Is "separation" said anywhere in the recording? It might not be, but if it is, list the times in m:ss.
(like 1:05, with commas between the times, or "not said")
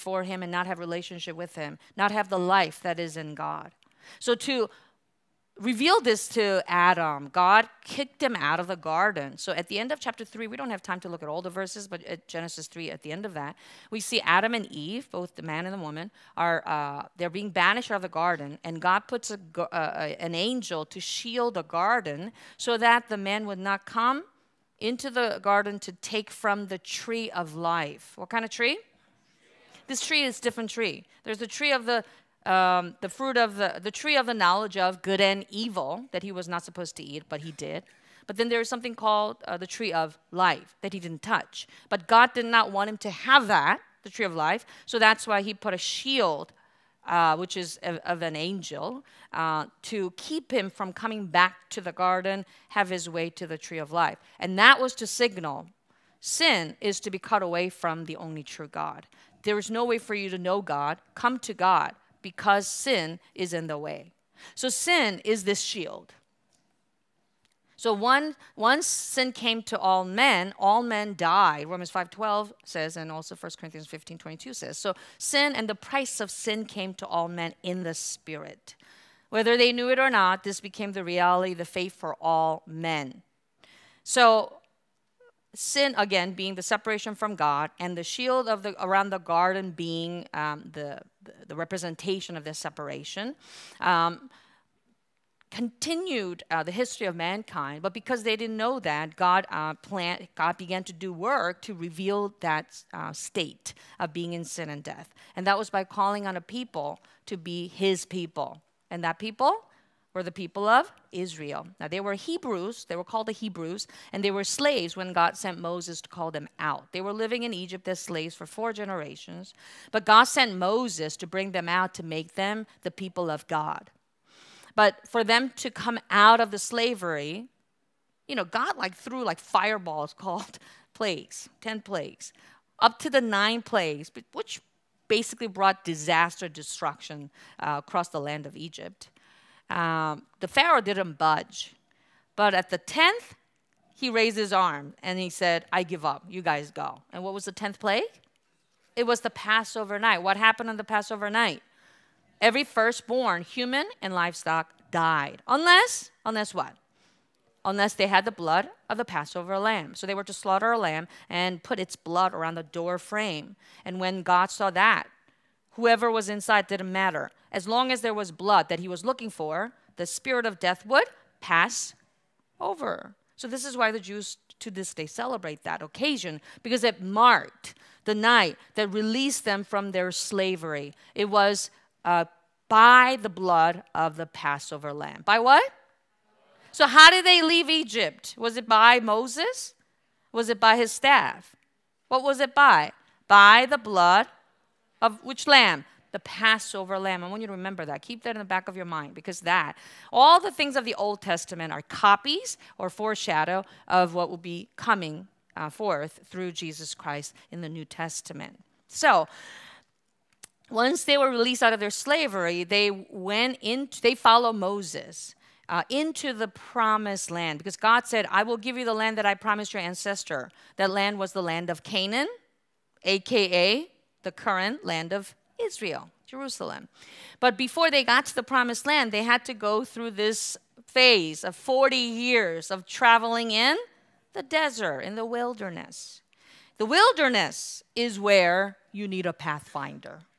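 1:26, 1:32.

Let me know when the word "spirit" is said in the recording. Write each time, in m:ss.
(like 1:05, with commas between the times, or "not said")
1:17, 2:50.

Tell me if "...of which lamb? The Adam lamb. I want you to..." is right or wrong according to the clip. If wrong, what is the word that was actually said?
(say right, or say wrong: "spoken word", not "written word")
wrong: "Passover", not "Adam".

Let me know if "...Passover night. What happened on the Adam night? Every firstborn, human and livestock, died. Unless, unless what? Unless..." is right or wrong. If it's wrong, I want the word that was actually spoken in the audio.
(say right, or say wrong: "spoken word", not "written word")
wrong: "Passover", not "Adam".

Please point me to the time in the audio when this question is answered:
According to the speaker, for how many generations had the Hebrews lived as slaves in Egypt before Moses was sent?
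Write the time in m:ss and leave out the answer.
1:58.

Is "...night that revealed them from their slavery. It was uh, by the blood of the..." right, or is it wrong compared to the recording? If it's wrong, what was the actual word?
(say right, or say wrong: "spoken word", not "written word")
wrong: "released", not "revealed".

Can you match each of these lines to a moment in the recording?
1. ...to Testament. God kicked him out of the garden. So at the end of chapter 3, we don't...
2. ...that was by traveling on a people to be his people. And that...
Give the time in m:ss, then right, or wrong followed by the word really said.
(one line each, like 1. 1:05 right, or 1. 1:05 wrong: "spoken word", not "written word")
1. 0:06 wrong: "Adam", not "Testament"
2. 1:45 wrong: "calling", not "traveling".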